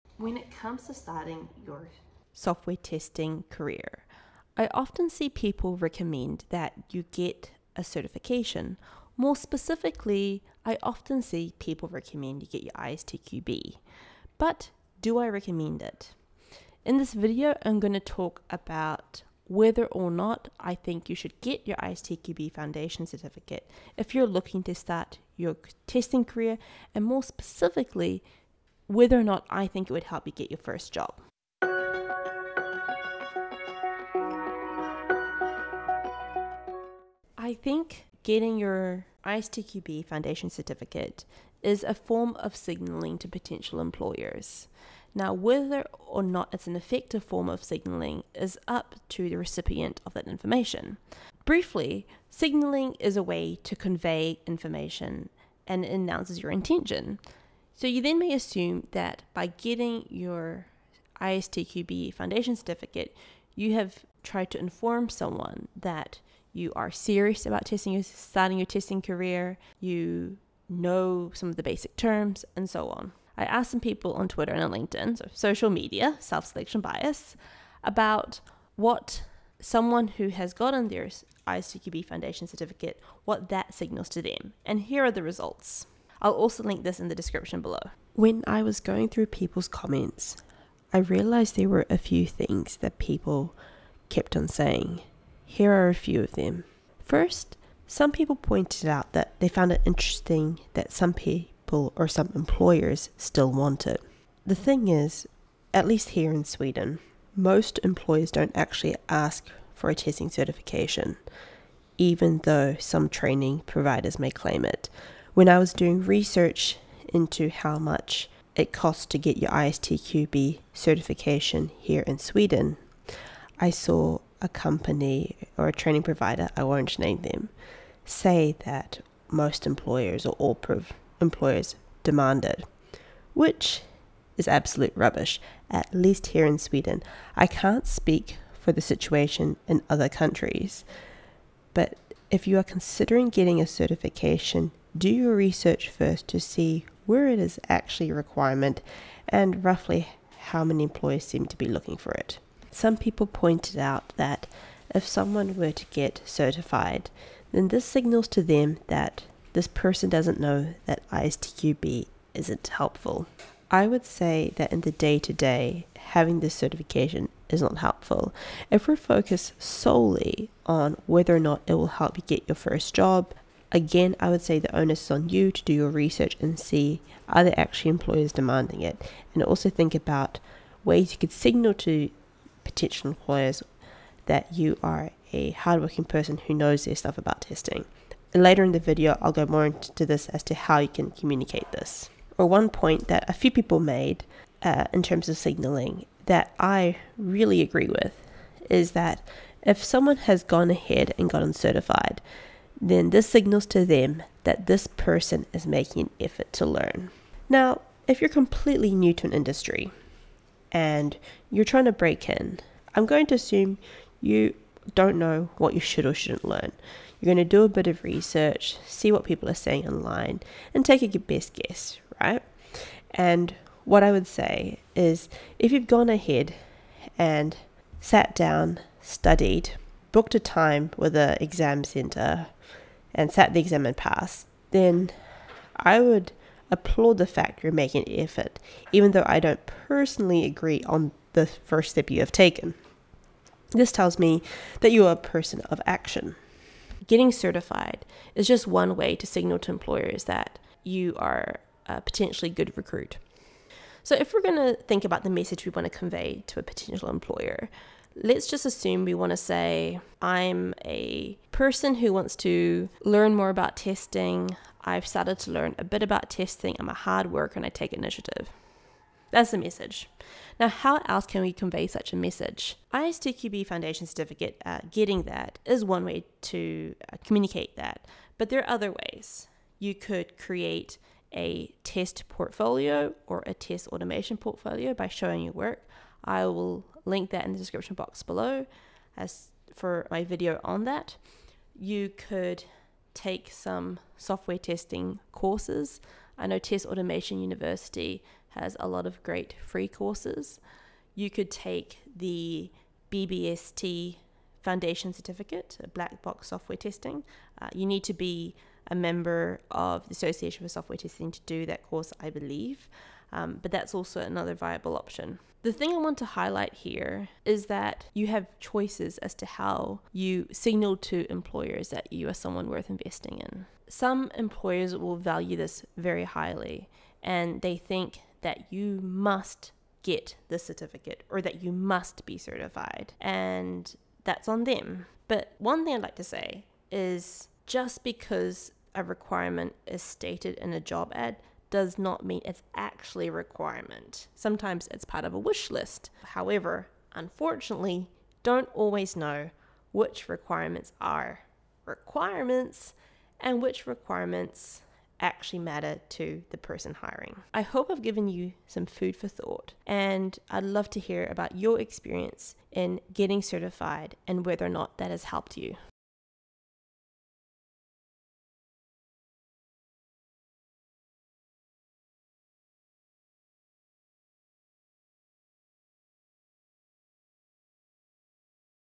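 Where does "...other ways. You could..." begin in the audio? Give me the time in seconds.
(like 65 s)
278 s.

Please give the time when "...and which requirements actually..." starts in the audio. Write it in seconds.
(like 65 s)
353 s.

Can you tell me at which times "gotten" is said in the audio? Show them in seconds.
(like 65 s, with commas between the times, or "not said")
80 s, 201 s.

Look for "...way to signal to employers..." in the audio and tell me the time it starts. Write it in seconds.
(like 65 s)
248 s.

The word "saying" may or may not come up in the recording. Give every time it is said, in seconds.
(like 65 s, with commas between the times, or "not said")
94 s, 219 s.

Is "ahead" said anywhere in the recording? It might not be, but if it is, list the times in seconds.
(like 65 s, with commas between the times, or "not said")
200 s, 226 s.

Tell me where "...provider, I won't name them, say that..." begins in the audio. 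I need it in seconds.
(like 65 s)
126 s.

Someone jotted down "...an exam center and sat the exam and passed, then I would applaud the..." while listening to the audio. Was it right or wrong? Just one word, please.
right.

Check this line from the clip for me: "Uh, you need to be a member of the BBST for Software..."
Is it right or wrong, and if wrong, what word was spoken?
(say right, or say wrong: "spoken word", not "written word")
wrong: "Association", not "BBST".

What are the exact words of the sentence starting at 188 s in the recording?
And later in the video, I'll go more into this as to how you can communicate this.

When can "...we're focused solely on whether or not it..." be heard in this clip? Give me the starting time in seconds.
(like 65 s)
168 s.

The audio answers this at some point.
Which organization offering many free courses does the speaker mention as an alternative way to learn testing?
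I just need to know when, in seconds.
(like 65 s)
296 s.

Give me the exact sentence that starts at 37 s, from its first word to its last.
I think getting your ISTQB foundation certificate is a form of signaling to potential employers.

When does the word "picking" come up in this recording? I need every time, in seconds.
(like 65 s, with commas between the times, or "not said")
not said.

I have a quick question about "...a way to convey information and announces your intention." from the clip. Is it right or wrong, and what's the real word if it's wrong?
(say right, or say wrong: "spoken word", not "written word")
right.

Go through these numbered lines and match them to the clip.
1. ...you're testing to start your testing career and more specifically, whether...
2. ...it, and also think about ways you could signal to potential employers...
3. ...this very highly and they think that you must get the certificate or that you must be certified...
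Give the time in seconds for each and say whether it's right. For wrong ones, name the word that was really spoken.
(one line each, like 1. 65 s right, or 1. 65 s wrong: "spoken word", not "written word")
1. 24 s wrong: "looking", not "testing"
2. 178 s right
3. 325 s right.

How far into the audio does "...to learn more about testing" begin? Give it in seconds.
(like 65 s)
262 s.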